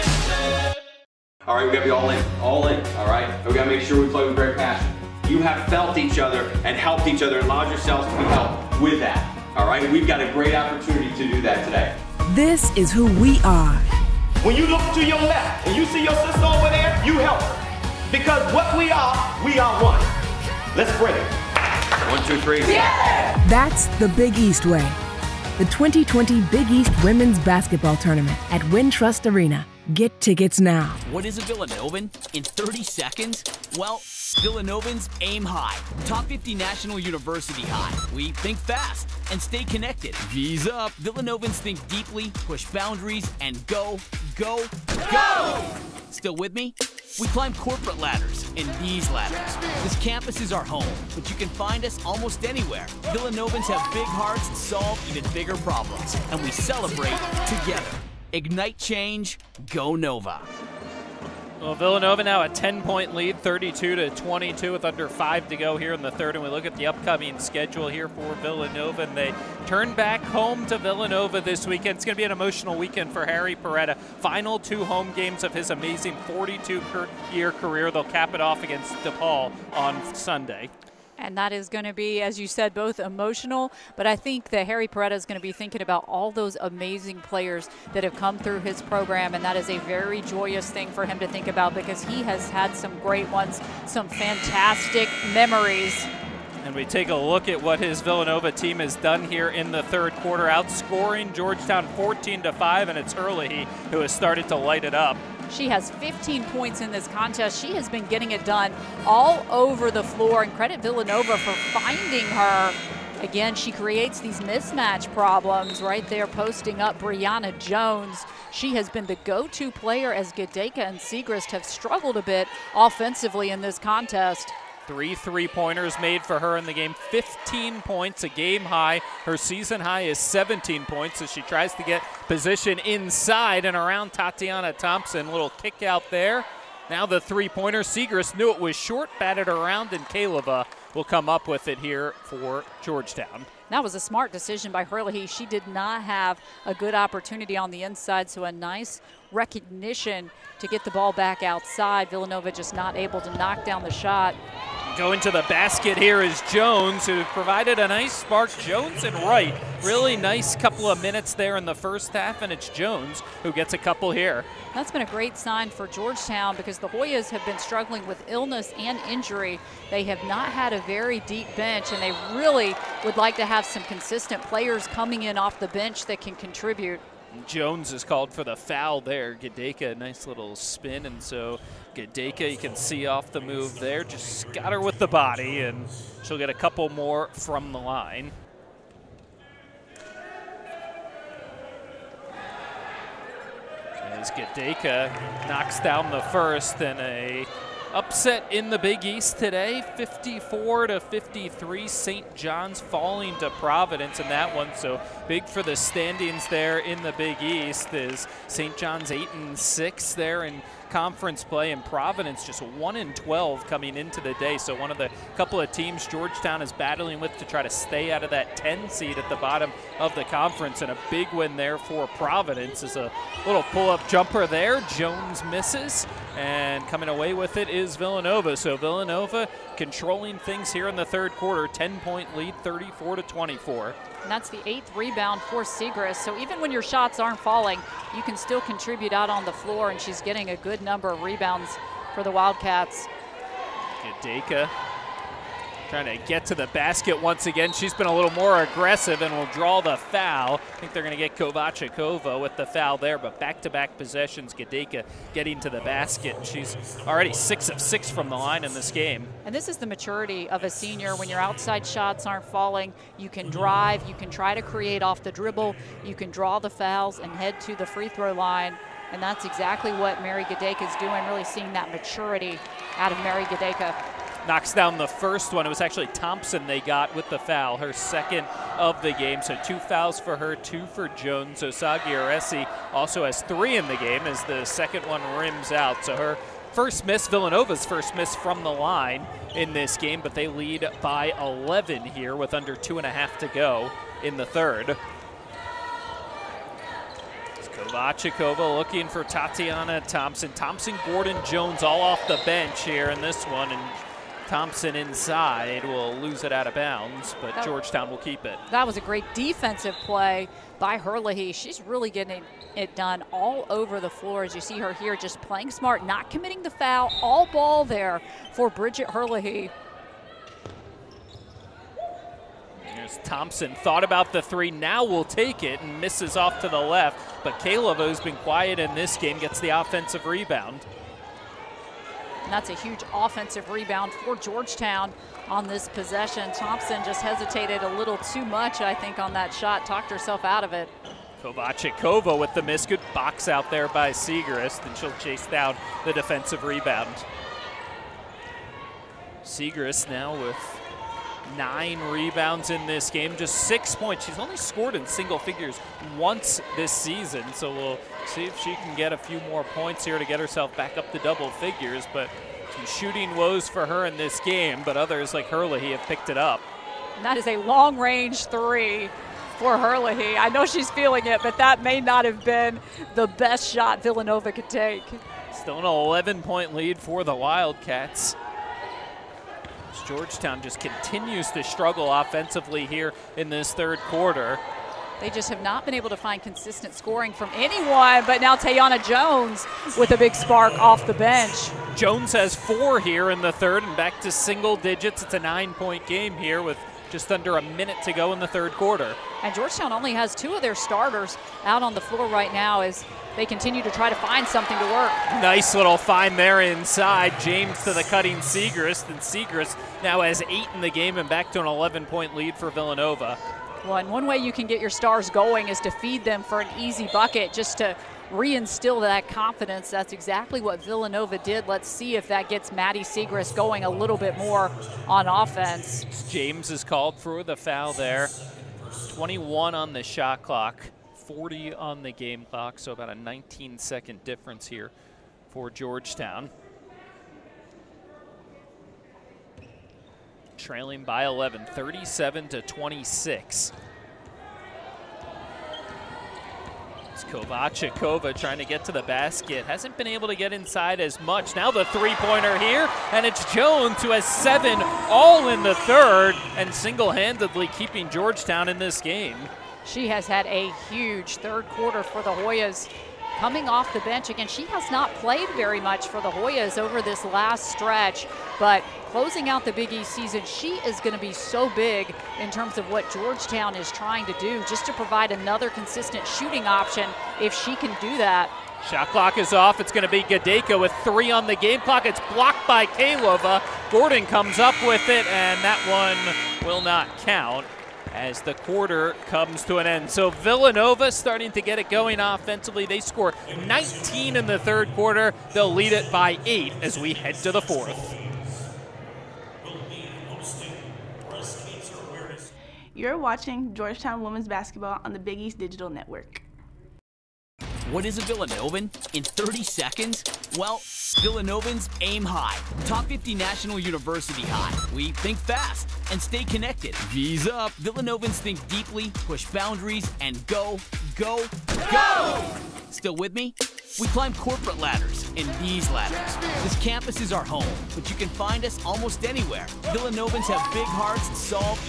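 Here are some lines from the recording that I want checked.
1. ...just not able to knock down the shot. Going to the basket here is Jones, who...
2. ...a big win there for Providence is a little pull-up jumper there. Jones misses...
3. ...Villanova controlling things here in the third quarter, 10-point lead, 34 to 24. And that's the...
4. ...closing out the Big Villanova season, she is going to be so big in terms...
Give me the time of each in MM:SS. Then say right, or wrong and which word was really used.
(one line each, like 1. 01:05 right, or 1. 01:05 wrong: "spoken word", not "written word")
1. 02:32 right
2. 03:40 right
3. 03:48 right
4. 07:49 wrong: "East", not "Villanova".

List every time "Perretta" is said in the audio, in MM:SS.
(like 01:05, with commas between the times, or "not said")
01:13, 01:24.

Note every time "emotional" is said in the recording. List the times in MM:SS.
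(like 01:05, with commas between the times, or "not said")
01:12, 01:22.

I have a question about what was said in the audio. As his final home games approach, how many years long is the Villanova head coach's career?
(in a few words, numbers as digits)
42.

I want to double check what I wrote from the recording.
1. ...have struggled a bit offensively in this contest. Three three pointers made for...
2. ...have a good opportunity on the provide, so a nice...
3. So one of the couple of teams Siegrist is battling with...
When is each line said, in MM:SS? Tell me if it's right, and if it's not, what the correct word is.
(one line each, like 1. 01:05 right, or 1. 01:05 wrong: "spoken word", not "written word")
1. 02:01 right
2. 02:26 wrong: "inside", not "provide"
3. 03:34 wrong: "Georgetown", not "Siegrist".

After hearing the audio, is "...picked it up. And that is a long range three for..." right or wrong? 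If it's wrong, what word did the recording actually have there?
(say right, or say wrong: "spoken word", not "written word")
right.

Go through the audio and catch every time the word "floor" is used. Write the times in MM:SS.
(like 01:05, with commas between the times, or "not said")
01:50, 03:59, 05:14, 06:42.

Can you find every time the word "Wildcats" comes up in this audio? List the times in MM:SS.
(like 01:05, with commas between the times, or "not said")
04:02, 06:17.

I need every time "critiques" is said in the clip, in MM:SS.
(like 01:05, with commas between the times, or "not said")
not said.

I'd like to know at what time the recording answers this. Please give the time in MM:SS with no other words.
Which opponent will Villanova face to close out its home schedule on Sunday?
01:19.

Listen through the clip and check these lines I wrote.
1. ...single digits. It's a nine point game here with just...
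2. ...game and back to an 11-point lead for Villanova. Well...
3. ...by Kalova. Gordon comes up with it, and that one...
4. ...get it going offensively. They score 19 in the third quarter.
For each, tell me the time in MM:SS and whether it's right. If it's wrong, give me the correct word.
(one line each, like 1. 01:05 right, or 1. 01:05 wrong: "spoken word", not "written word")
1. 06:34 right
2. 06:50 right
3. 08:02 right
4. 08:11 right.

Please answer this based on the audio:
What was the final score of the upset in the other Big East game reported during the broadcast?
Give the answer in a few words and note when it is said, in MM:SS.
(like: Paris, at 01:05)
54 to 53, at 03:19.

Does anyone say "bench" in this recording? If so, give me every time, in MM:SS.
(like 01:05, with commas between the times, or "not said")
02:51, 02:55, 05:02, 06:31, 07:44.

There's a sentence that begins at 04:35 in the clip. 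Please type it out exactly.
It was actually Thompson they got with the foul, her second of the game.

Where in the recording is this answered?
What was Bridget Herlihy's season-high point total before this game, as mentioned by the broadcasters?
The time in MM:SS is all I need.
02:10.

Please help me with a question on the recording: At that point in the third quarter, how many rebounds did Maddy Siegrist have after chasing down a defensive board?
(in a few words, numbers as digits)
9.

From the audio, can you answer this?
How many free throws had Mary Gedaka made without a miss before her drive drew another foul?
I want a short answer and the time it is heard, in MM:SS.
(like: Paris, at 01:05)
6 of 6, at 04:17.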